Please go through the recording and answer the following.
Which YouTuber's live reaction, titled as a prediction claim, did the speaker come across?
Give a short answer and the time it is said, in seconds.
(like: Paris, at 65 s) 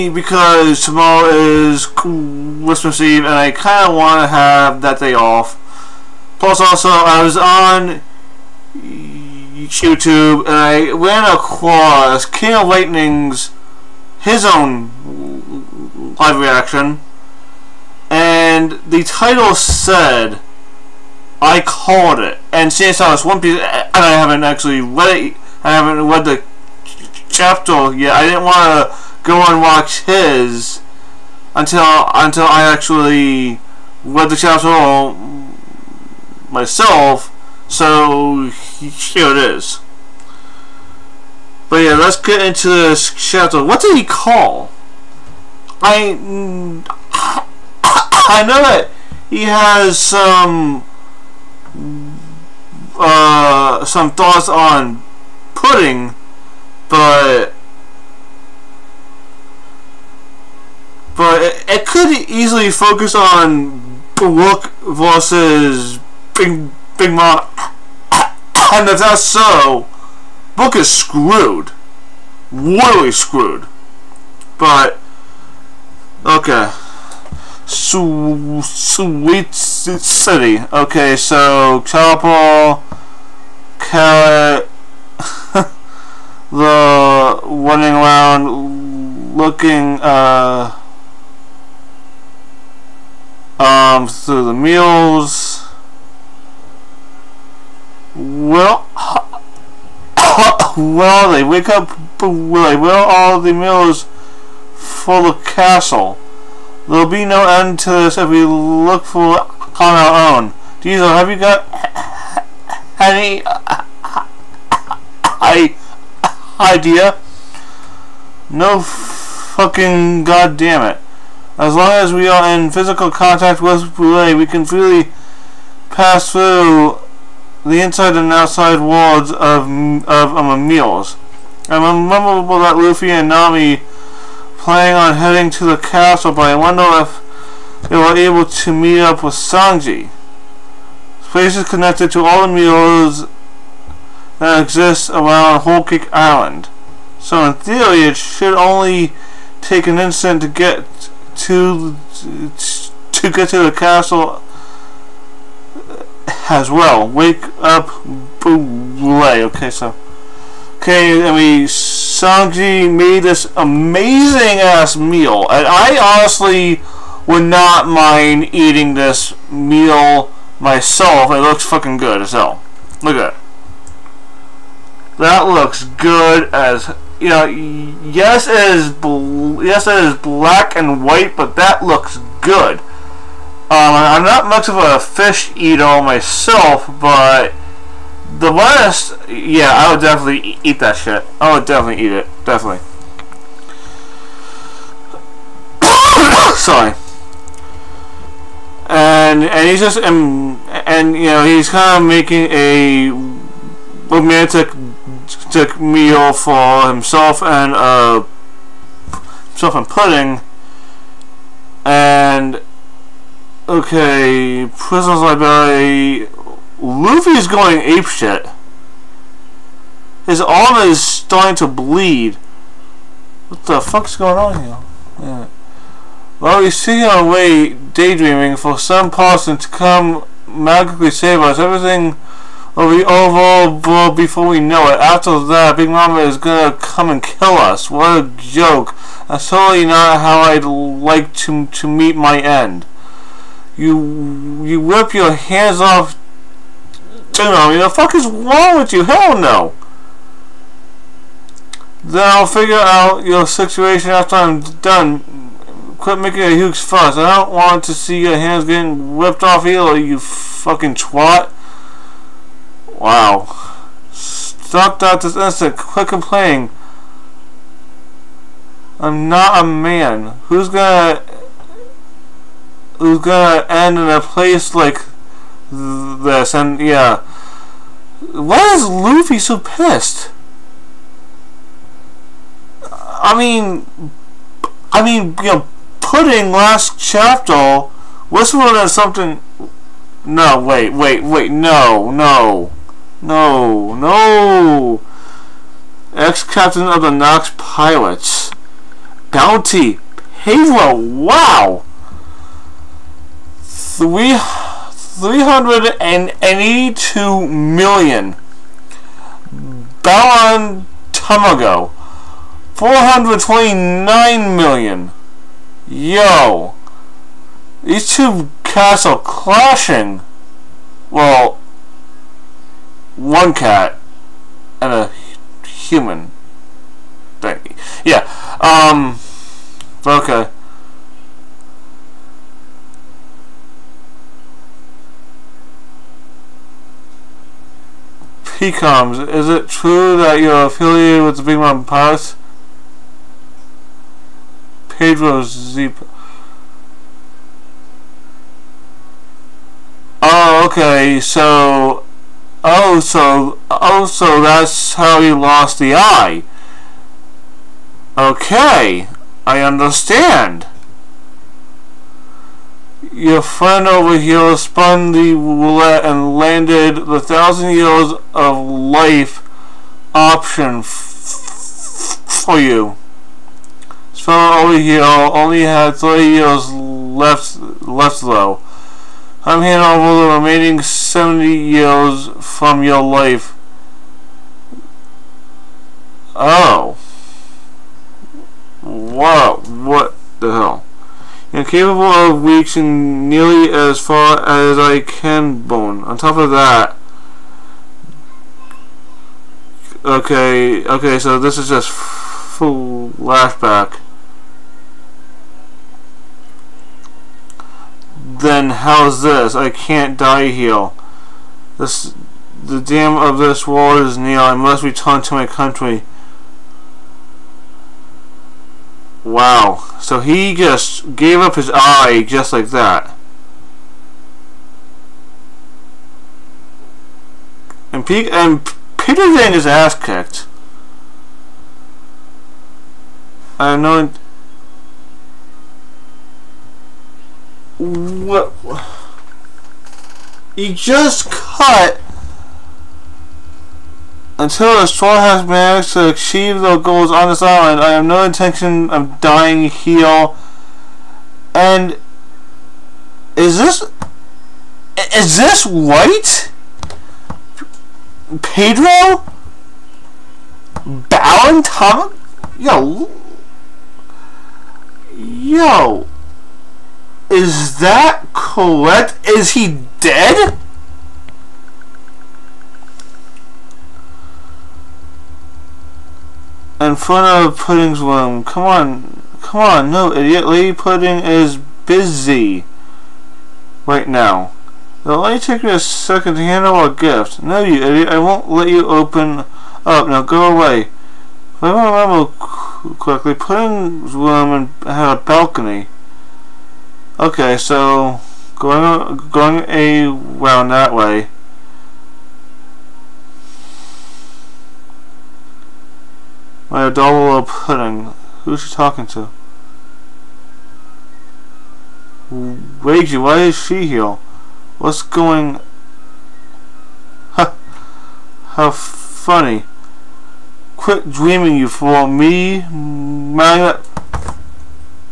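King of Lightning, at 12 s.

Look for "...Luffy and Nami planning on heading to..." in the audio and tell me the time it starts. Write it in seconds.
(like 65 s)
132 s.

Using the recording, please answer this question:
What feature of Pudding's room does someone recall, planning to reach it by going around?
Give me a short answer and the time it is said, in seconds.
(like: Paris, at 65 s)
a balcony, at 495 s.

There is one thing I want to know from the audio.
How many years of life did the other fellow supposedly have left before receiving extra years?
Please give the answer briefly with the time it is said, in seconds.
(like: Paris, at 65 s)
30 years, at 375 s.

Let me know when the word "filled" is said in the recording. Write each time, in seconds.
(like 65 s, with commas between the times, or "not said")
not said.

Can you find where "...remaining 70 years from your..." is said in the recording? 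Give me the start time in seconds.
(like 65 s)
380 s.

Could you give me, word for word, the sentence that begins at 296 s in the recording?
Ex captain of the Nox pilots, Bounty.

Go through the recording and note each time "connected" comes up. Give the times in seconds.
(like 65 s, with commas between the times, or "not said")
141 s.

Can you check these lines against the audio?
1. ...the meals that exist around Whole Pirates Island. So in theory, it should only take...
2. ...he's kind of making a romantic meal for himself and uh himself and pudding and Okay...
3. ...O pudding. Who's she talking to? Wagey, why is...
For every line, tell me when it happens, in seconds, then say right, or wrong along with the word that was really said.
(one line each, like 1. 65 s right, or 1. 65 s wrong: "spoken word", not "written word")
1. 142 s wrong: "Cake", not "Pirates"
2. 201 s right
3. 507 s right.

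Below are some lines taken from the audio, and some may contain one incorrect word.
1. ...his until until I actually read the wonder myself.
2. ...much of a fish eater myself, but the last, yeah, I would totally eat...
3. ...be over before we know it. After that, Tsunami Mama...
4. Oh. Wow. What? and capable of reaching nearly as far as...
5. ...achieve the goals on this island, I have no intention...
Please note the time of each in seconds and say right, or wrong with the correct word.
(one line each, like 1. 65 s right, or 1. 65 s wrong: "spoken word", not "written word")
1. 30 s wrong: "chapter", not "wonder"
2. 184 s wrong: "definitely", not "totally"
3. 232 s wrong: "Big", not "Tsunami"
4. 386 s right
5. 446 s right.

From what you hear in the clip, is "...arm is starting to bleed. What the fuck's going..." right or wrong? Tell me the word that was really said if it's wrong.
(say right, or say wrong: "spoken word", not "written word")
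right.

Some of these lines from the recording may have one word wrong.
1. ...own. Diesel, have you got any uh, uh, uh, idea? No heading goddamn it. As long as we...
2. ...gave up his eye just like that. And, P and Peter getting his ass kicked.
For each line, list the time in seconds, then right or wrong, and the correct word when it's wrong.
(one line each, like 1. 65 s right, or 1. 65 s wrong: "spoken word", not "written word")
1. 110 s wrong: "fucking", not "heading"
2. 421 s right.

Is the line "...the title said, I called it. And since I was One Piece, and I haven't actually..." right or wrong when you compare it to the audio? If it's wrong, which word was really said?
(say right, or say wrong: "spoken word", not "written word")
right.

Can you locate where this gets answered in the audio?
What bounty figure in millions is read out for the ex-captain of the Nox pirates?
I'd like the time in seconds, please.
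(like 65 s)
304 s.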